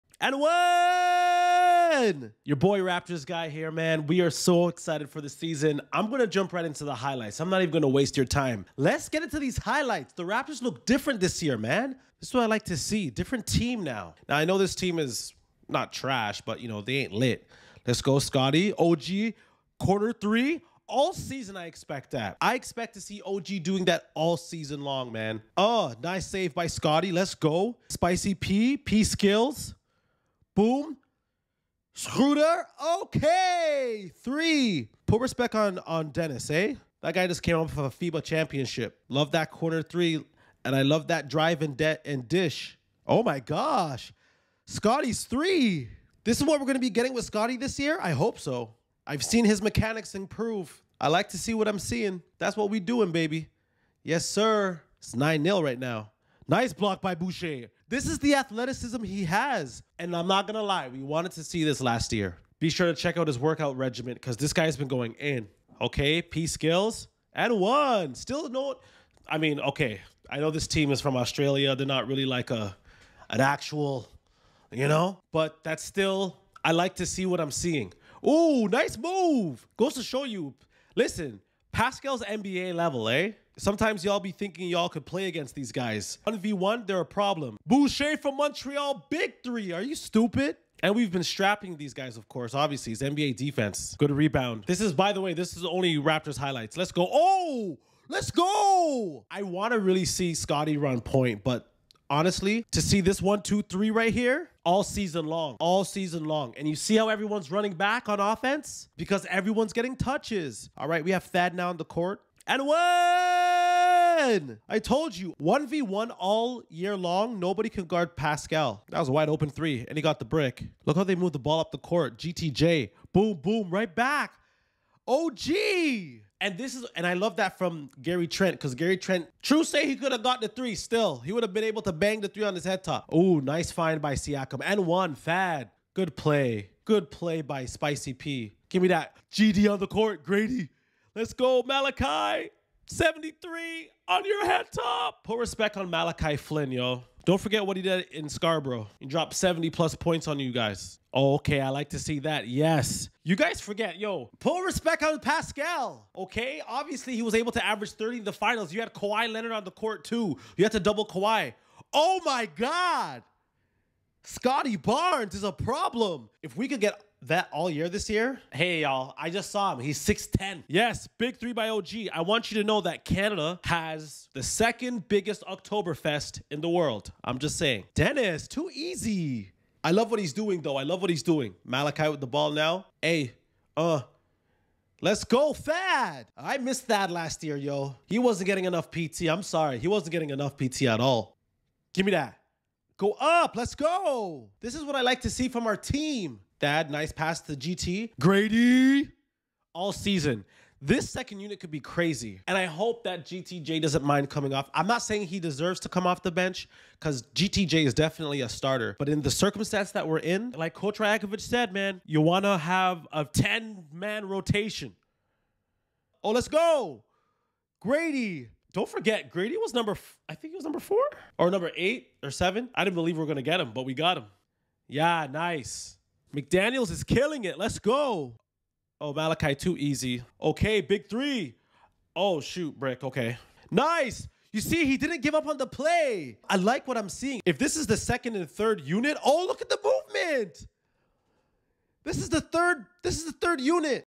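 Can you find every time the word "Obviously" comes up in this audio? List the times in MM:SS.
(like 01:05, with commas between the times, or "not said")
01:32, 02:36.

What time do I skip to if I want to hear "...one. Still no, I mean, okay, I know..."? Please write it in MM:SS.
01:07.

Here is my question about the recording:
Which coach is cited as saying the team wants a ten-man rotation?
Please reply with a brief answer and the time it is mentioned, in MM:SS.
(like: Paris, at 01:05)
Coach Rajakovic, at 03:30.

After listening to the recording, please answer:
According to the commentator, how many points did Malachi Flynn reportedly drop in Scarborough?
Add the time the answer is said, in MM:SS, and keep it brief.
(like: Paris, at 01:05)
70 plus, at 02:29.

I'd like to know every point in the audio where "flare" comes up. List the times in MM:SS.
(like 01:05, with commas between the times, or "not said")
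not said.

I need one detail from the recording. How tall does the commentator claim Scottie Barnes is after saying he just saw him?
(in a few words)
6'10.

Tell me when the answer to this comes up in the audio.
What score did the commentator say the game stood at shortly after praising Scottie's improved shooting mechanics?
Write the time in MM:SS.
00:55.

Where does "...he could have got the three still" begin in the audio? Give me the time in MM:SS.
02:09.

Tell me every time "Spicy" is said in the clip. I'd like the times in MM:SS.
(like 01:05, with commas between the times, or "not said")
00:27, 02:17.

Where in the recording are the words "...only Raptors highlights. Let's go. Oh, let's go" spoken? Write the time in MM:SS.
01:35.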